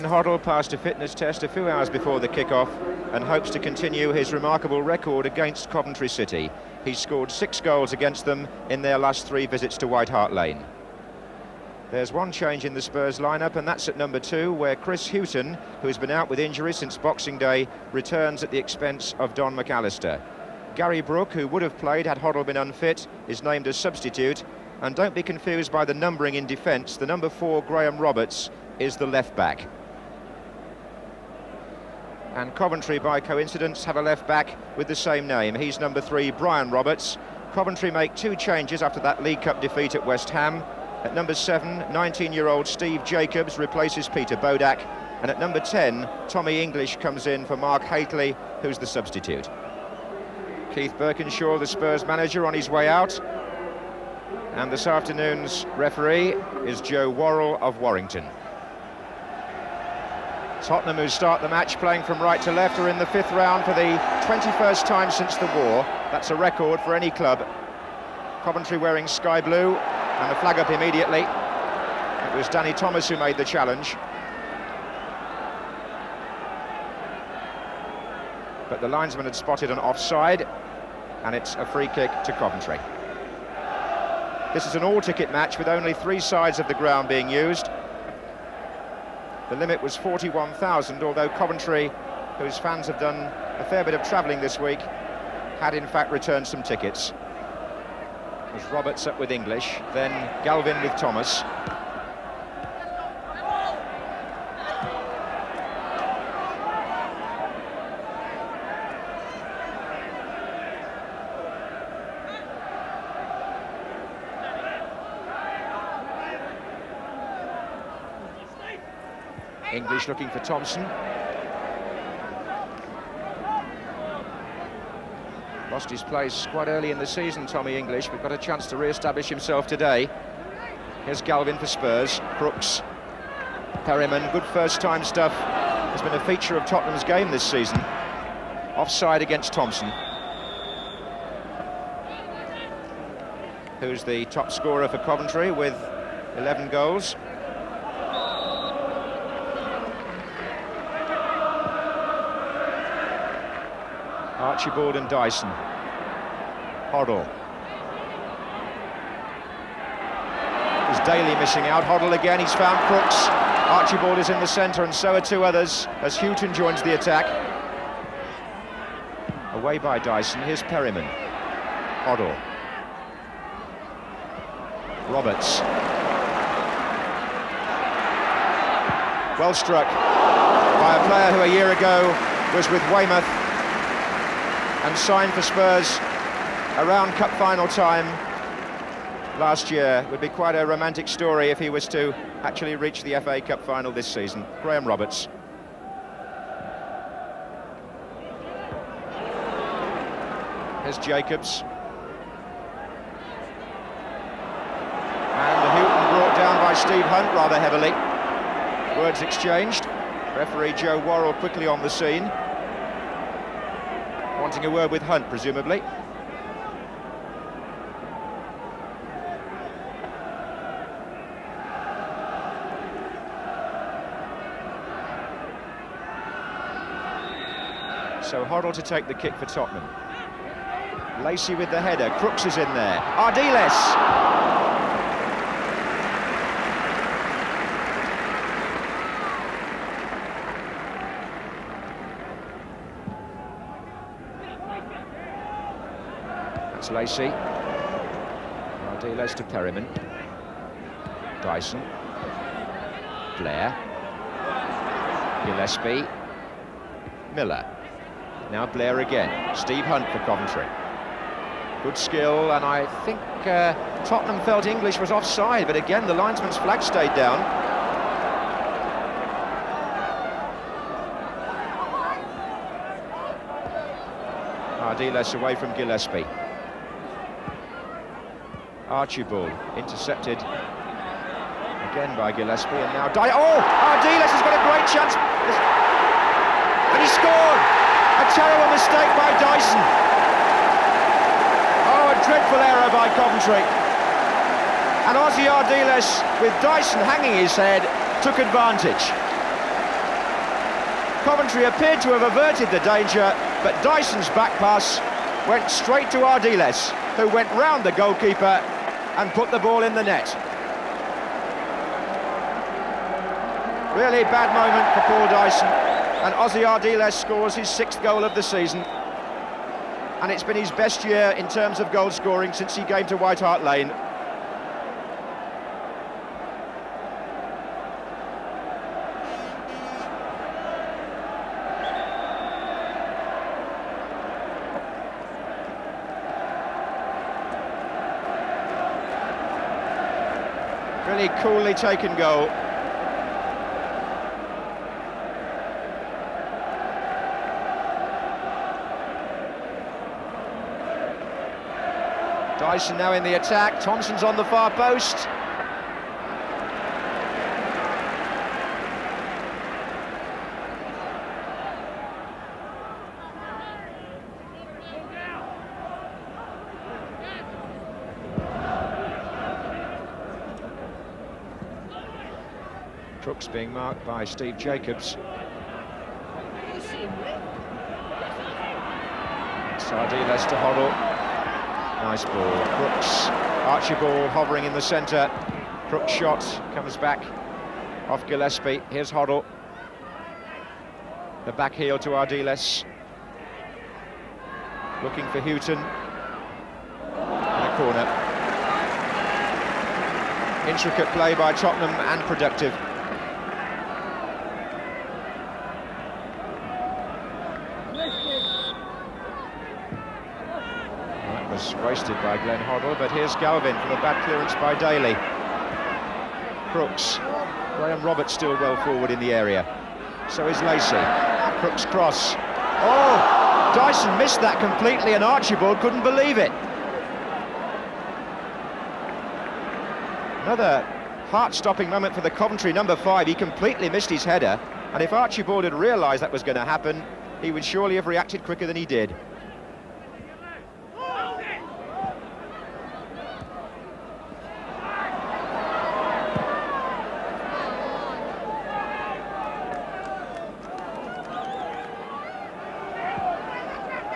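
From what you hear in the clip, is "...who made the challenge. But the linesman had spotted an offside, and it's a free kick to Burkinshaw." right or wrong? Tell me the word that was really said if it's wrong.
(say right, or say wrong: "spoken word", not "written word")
wrong: "Coventry", not "Burkinshaw".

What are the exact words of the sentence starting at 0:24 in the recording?
And don't be confused by the numbering in defence.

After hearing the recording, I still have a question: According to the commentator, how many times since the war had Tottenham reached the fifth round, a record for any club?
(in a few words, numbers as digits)
21.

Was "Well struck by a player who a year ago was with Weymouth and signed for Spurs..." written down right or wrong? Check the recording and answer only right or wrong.
right.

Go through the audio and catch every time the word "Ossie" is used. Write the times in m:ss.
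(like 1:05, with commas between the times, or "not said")
4:55, 5:16.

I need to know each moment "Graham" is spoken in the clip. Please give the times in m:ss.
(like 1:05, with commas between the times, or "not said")
0:27, 3:14, 6:57.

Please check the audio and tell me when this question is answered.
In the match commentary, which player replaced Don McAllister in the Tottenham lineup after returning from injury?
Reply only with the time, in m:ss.
0:14.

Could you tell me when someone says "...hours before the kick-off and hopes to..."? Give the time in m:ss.
0:01.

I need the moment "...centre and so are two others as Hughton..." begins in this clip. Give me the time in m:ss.
2:44.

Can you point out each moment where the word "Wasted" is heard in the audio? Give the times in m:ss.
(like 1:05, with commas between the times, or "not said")
6:51.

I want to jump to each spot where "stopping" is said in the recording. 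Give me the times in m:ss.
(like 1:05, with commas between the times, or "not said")
7:11.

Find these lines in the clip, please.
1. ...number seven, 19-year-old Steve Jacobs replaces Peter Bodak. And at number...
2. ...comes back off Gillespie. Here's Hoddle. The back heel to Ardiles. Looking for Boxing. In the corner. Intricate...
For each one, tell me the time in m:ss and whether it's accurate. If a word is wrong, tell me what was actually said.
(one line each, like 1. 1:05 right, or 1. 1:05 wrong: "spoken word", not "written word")
1. 0:41 right
2. 6:26 wrong: "Hughton", not "Boxing".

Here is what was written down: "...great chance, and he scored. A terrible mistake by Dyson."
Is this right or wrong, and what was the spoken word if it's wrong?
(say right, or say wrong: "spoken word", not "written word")
right.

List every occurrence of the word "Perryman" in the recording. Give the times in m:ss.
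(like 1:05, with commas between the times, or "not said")
2:13, 2:50, 4:09.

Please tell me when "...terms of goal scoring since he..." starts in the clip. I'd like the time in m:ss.
5:21.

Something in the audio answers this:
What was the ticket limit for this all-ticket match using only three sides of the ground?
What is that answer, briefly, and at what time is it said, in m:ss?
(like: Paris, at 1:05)
41,000, at 1:29.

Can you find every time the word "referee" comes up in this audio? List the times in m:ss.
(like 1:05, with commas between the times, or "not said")
0:55, 3:30.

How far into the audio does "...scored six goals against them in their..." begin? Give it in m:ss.
0:06.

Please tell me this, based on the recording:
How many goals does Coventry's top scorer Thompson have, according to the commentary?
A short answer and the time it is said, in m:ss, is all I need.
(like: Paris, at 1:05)
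11, at 2:26.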